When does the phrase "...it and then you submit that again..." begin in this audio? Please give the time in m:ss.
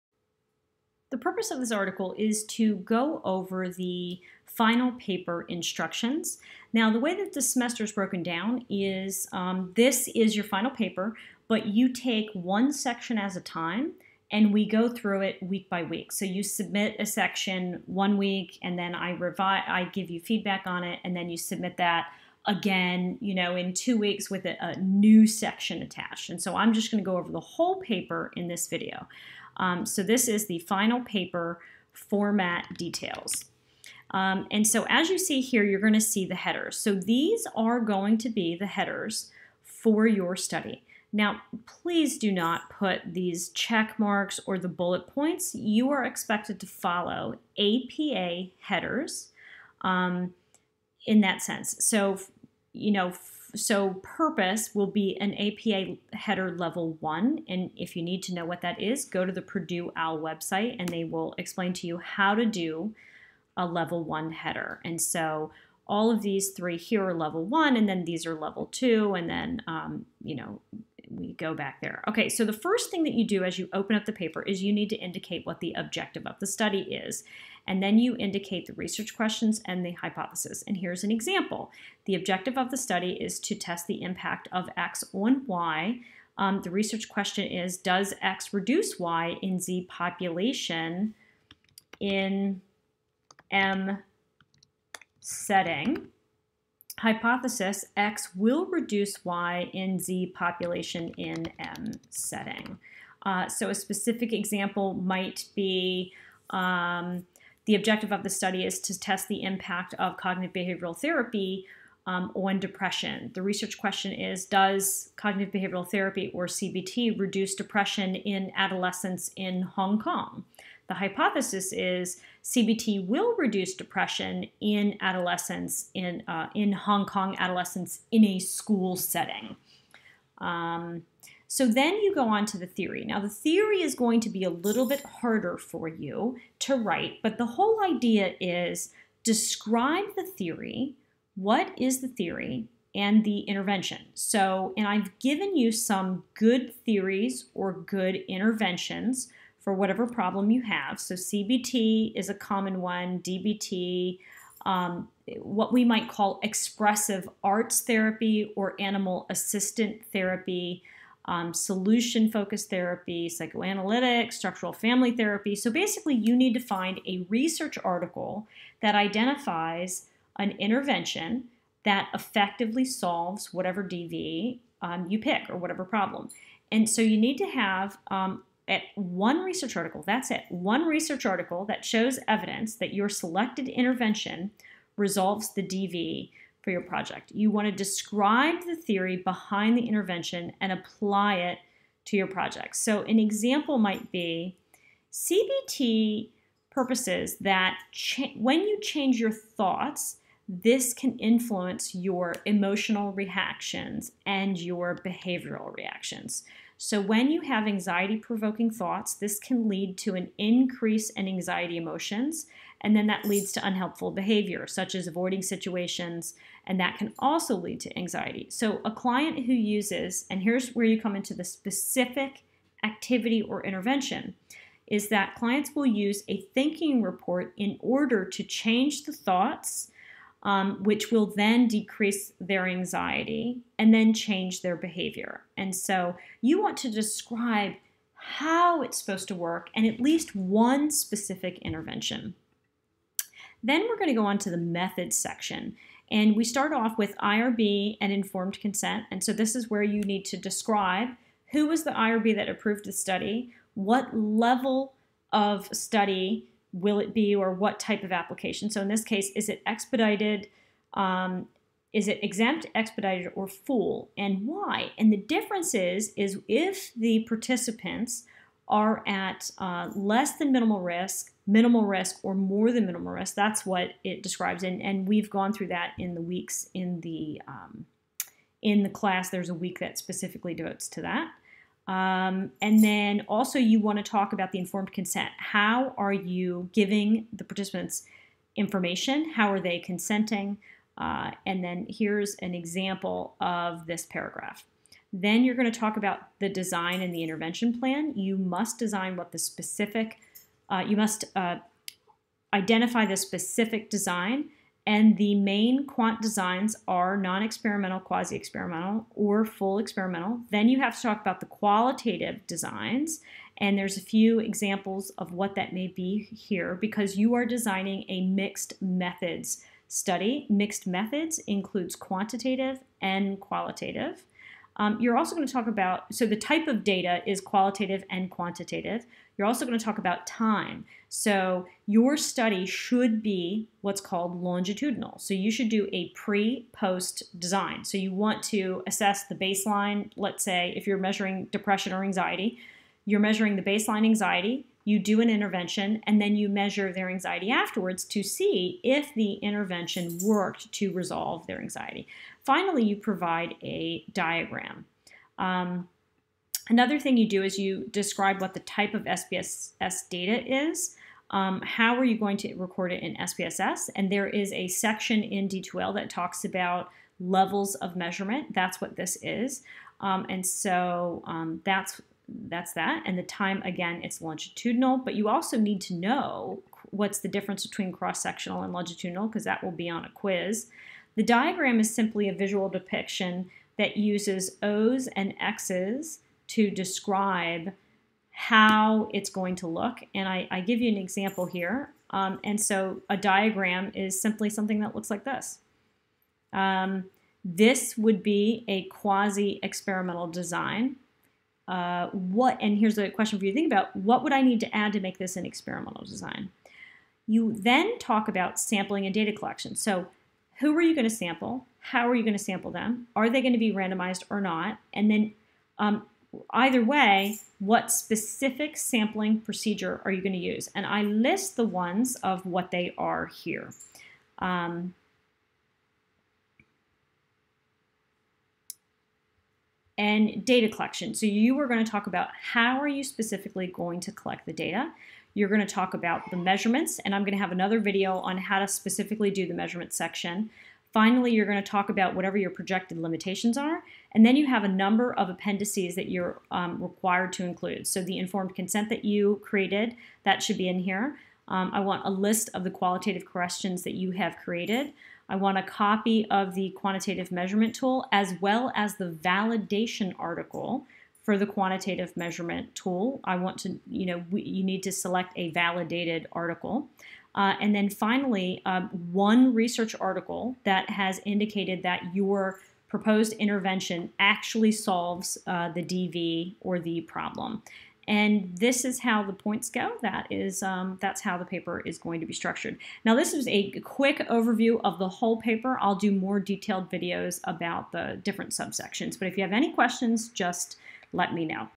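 0:20.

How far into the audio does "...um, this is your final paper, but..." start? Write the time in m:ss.
0:09.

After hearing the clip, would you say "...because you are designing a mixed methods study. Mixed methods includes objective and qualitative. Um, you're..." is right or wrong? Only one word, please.
wrong.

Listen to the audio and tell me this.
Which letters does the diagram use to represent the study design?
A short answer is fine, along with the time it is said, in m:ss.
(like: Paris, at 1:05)
O's and X's, at 6:24.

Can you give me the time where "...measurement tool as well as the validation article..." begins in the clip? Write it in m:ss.
7:37.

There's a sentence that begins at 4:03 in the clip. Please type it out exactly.
Then we're going to go on to the methods section.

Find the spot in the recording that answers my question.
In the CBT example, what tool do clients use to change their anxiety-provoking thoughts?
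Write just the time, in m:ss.
3:46.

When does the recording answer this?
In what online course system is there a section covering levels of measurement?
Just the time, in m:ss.
6:05.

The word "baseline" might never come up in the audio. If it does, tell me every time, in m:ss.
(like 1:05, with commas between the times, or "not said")
5:39, 5:43.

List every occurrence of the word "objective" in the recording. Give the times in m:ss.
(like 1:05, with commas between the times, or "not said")
1:15, 1:22, 1:47.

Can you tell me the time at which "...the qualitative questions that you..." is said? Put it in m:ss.
7:32.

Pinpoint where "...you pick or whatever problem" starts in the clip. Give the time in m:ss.
2:55.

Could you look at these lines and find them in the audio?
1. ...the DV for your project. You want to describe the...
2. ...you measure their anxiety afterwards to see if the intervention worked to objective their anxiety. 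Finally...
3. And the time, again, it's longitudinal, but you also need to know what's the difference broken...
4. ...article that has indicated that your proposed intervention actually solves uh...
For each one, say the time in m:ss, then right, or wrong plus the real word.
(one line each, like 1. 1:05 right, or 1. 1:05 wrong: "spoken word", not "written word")
1. 3:05 right
2. 5:46 wrong: "resolve", not "objective"
3. 6:13 wrong: "between", not "broken"
4. 7:50 right.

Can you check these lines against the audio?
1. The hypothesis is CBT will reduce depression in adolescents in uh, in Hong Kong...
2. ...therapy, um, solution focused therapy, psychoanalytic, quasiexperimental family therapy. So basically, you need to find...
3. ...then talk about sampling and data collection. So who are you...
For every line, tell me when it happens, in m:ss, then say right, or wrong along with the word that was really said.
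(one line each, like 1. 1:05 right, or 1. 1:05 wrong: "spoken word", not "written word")
1. 2:00 right
2. 2:40 wrong: "structural", not "quasiexperimental"
3. 6:47 right.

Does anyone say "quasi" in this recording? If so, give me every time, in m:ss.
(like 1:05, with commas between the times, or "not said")
5:07, 6:38.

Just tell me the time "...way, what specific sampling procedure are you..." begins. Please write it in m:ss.
6:56.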